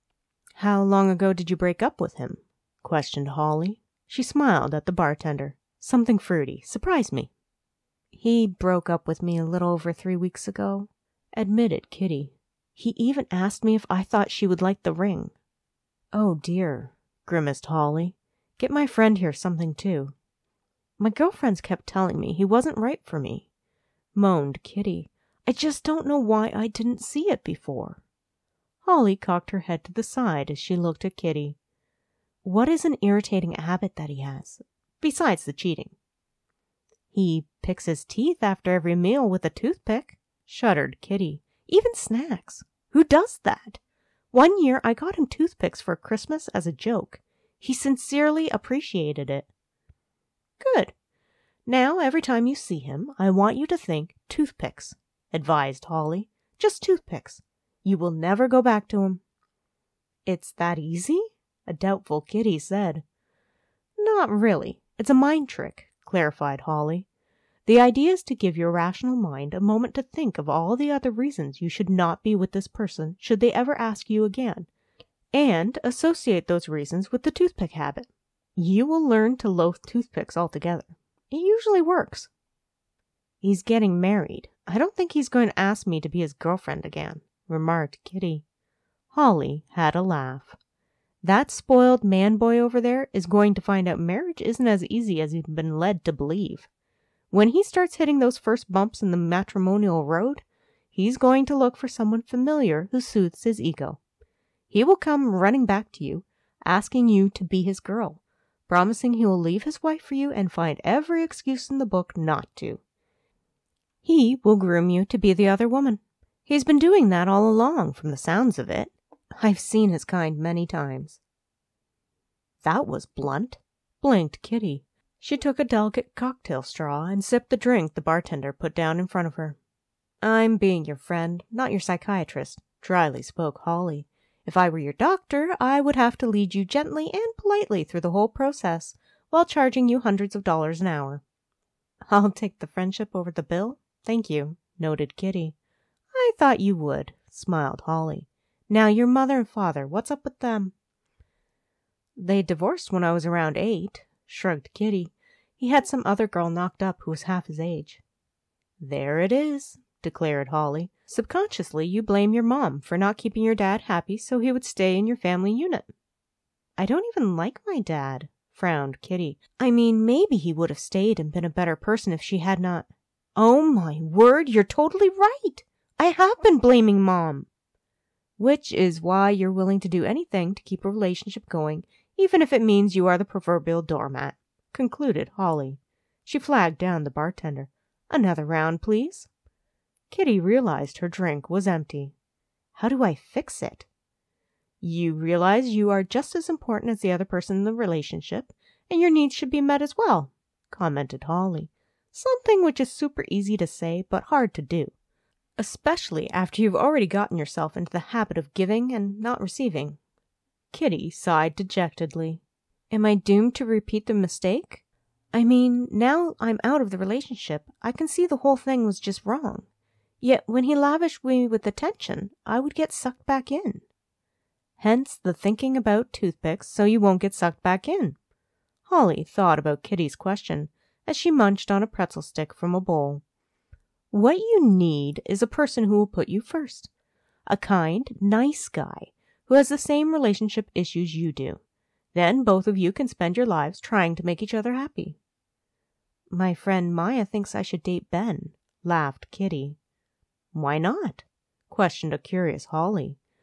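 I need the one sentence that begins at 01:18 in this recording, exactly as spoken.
You will learn to loathe toothpicks altogether.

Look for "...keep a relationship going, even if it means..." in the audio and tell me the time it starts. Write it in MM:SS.
03:00.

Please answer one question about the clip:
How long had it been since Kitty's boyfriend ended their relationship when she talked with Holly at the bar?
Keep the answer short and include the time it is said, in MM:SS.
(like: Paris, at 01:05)
a little over 3 weeks, at 00:09.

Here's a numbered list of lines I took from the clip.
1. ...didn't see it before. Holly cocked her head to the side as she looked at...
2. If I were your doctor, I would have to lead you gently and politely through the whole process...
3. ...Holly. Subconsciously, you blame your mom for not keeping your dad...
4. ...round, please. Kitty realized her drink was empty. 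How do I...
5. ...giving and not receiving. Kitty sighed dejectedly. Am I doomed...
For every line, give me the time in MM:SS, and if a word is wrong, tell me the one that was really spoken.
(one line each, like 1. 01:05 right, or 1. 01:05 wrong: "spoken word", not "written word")
1. 00:26 right
2. 02:14 right
3. 02:40 right
4. 03:08 right
5. 03:28 right.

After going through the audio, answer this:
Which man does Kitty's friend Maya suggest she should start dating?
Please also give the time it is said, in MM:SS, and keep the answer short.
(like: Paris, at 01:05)
Ben, at 04:08.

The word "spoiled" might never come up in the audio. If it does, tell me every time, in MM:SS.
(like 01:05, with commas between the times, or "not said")
01:31.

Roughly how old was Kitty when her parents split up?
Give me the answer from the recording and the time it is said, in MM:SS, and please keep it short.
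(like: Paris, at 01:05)
8, at 02:33.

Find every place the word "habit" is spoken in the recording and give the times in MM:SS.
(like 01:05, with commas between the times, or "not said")
00:33, 01:17, 03:27.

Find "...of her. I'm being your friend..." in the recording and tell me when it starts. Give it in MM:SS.
02:09.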